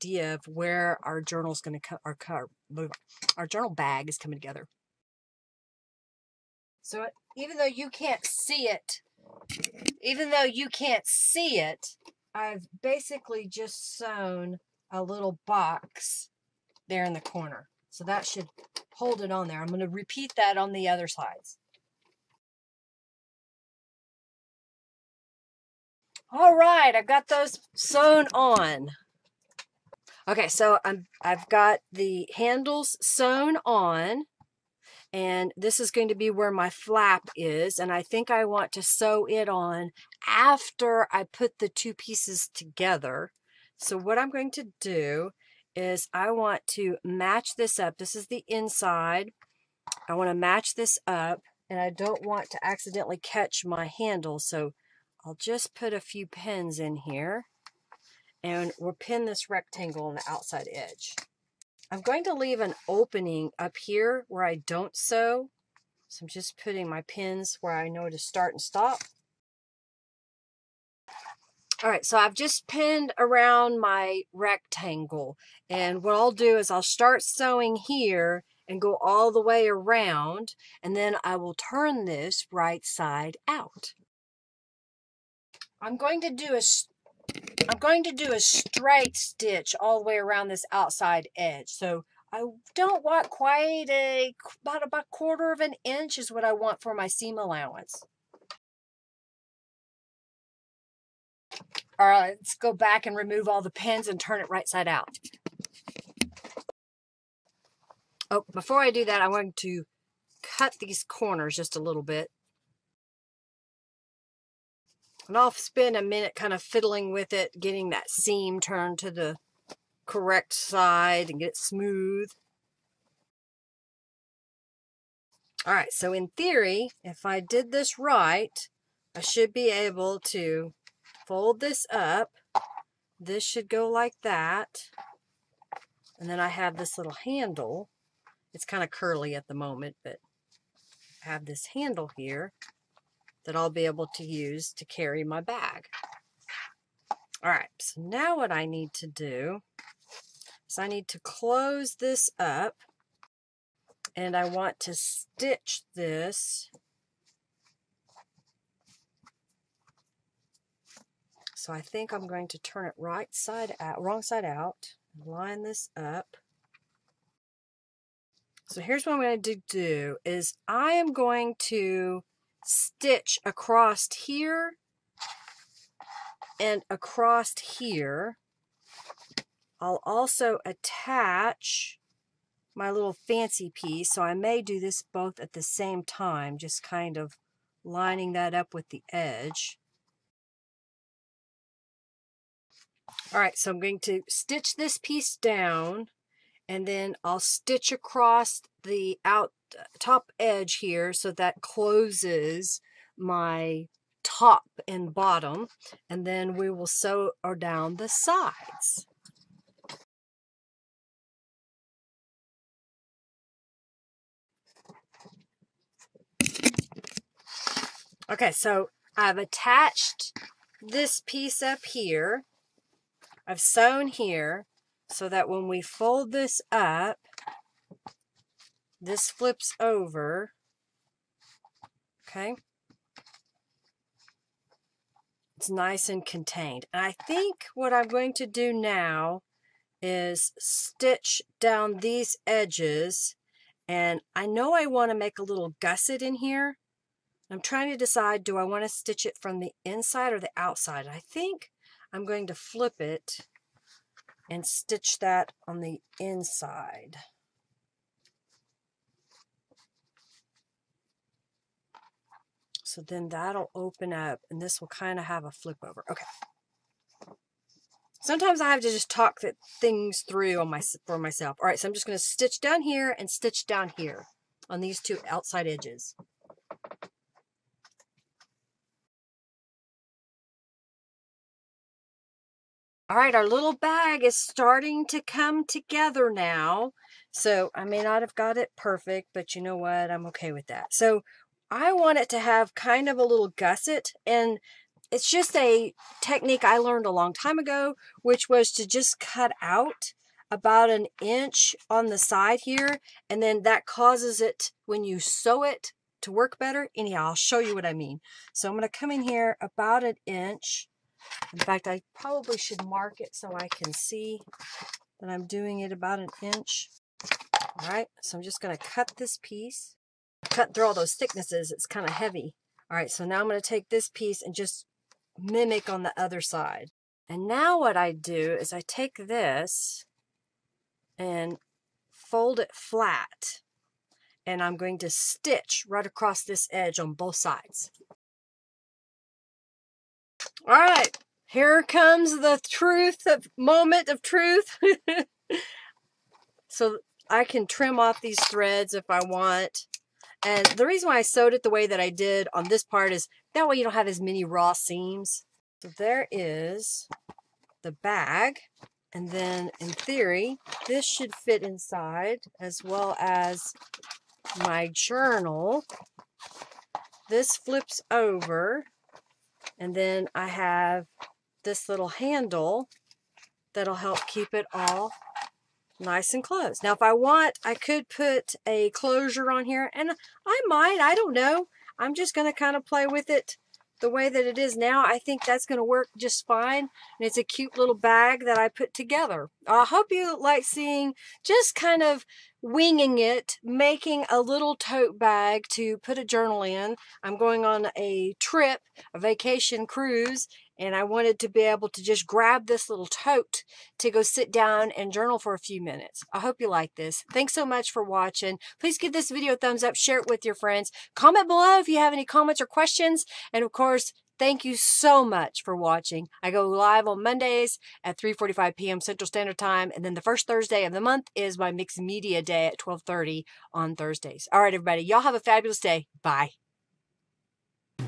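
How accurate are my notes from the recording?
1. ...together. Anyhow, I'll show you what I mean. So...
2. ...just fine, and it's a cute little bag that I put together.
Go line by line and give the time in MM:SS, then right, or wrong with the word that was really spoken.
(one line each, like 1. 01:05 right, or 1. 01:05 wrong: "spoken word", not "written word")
1. 05:06 wrong: "better", not "together"
2. 06:26 right.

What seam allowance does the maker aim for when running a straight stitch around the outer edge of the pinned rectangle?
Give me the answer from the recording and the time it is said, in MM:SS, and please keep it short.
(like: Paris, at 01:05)
a quarter of an inch, at 01:34.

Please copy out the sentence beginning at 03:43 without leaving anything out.
I've sewn here so that when we fold this up, this flips over.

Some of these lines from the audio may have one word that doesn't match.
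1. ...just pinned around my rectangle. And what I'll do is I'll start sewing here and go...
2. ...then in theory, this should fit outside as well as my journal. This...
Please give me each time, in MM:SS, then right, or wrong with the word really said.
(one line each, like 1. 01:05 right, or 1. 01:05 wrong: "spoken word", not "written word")
1. 01:12 right
2. 05:59 wrong: "inside", not "outside".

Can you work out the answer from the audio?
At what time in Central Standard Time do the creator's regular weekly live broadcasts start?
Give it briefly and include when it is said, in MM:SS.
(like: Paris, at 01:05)
3:45 p.m., at 06:58.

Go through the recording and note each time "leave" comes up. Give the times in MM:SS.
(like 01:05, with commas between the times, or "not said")
01:02.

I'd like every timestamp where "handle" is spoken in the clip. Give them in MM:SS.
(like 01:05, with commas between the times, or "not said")
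00:32, 00:53, 02:17, 02:21, 06:12.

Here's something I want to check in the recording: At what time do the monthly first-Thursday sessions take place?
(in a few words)
12:30.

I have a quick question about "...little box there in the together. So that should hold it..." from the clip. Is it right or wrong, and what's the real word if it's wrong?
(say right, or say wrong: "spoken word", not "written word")
wrong: "corner", not "together".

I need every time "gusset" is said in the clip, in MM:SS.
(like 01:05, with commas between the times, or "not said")
04:05, 04:53.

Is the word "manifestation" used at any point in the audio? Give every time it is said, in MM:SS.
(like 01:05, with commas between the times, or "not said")
not said.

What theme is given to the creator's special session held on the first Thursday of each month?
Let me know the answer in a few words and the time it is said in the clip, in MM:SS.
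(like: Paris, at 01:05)
mixed media day, at 07:01.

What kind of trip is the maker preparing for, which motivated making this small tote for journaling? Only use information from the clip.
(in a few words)
vacation cruise.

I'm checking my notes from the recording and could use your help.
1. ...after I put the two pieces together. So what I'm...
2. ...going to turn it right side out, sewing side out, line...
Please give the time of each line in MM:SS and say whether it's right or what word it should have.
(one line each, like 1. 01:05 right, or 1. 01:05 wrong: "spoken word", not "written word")
1. 00:40 right
2. 02:42 wrong: "wrong", not "sewing".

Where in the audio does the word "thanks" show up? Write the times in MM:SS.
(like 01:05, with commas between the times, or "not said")
06:47, 06:54.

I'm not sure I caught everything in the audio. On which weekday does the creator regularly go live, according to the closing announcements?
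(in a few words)
Mondays.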